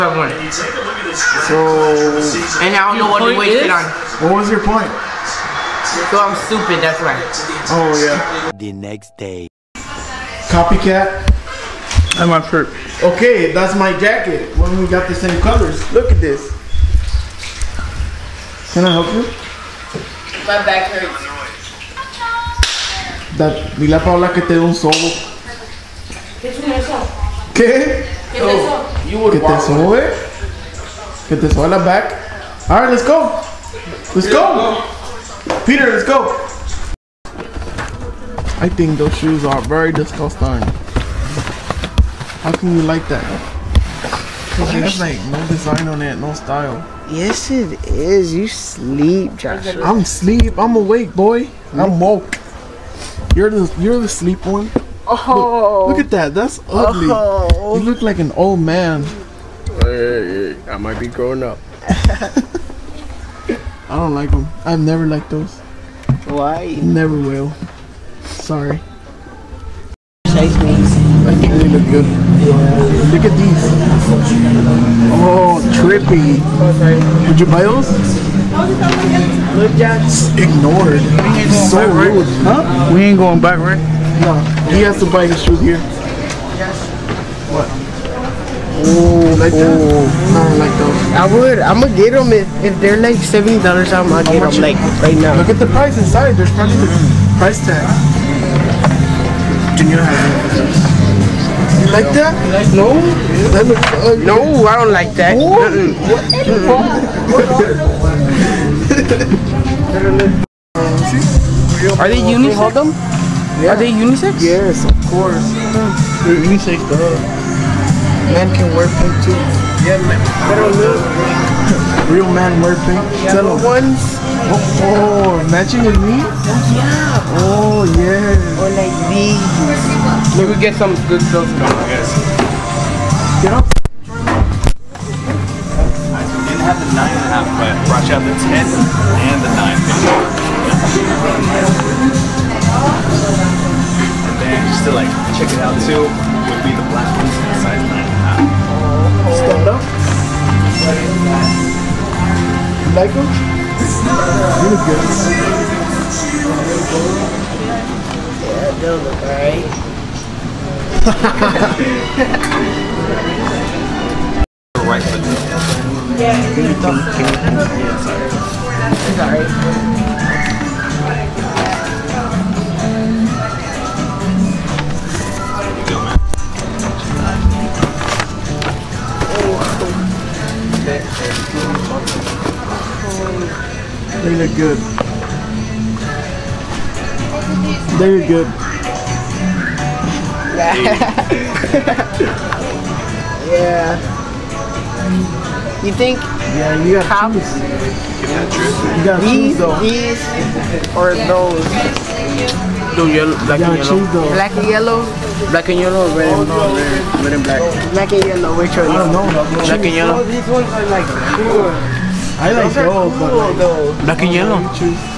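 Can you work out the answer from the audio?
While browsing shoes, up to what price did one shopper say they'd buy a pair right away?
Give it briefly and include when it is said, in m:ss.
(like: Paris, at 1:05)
$70, at 1:33.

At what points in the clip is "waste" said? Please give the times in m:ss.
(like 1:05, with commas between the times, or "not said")
0:03.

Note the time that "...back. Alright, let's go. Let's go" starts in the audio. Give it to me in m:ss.
0:31.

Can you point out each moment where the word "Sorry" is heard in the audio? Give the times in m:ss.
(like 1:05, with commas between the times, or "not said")
1:08.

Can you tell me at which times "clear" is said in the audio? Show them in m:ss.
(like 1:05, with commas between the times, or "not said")
not said.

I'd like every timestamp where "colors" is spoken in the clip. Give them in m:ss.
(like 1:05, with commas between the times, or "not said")
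0:15.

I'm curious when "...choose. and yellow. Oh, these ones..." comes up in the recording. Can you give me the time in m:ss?
3:29.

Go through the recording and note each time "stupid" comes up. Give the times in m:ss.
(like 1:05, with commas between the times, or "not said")
0:06.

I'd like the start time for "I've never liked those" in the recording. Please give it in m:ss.
1:04.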